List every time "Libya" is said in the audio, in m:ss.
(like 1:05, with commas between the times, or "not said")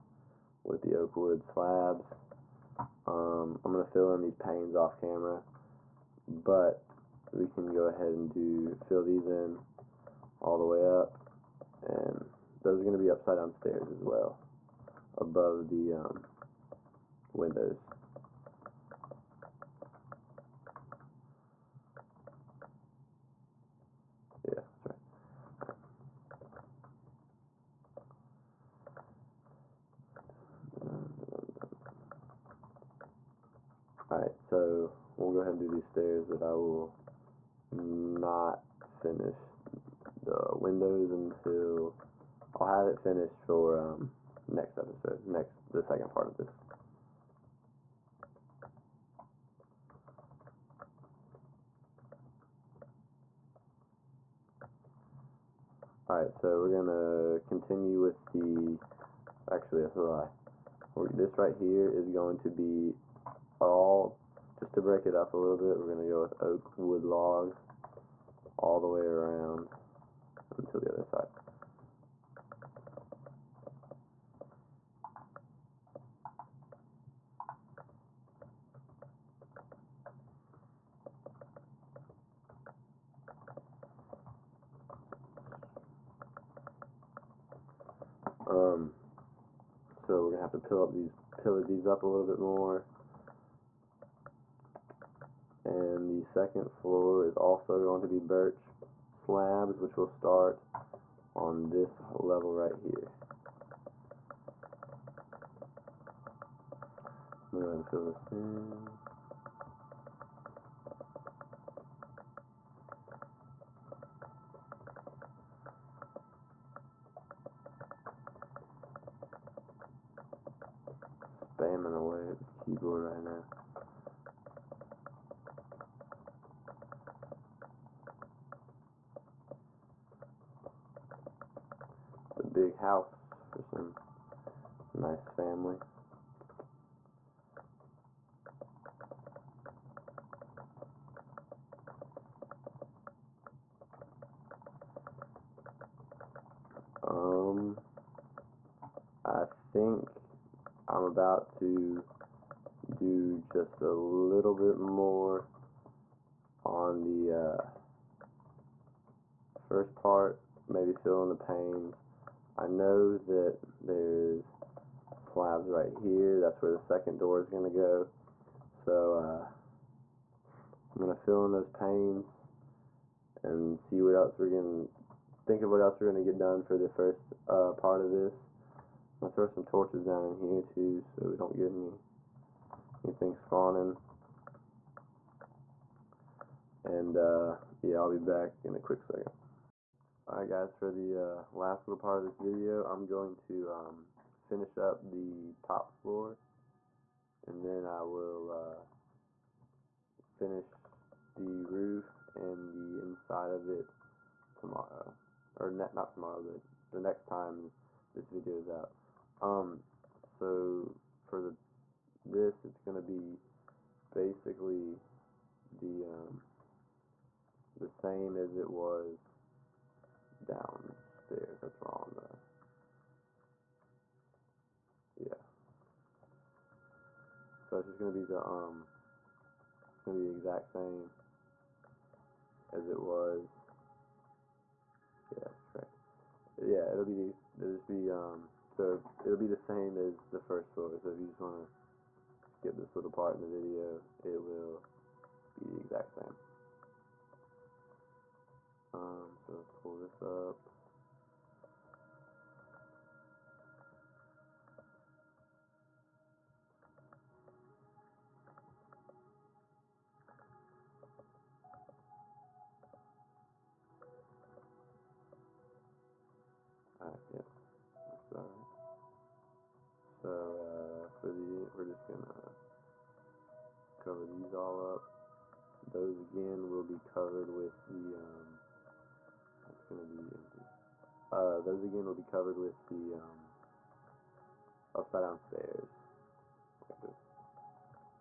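not said.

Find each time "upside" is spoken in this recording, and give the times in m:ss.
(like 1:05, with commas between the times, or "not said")
0:13, 4:44.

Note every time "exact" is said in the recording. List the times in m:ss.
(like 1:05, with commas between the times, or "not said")
3:50, 4:05.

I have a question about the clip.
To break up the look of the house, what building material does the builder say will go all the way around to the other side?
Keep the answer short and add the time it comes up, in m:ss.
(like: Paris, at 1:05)
Oak wood logs, at 1:06.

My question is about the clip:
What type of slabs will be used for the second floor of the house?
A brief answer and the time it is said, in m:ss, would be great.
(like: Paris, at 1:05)
Birch slabs, at 1:38.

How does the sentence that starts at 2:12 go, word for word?
It's a big house for some nice family.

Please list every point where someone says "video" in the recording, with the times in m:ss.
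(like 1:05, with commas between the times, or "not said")
3:12, 3:28, 4:03.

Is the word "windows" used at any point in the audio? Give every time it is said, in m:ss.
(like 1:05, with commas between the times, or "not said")
0:17, 0:40.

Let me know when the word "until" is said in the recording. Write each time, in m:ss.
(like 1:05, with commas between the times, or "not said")
0:41, 1:10.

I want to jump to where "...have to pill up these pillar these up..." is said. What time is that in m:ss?
1:30.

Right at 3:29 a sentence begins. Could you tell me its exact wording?
Um, so for the this, it's going to be basically the um, the same as it was downstairs.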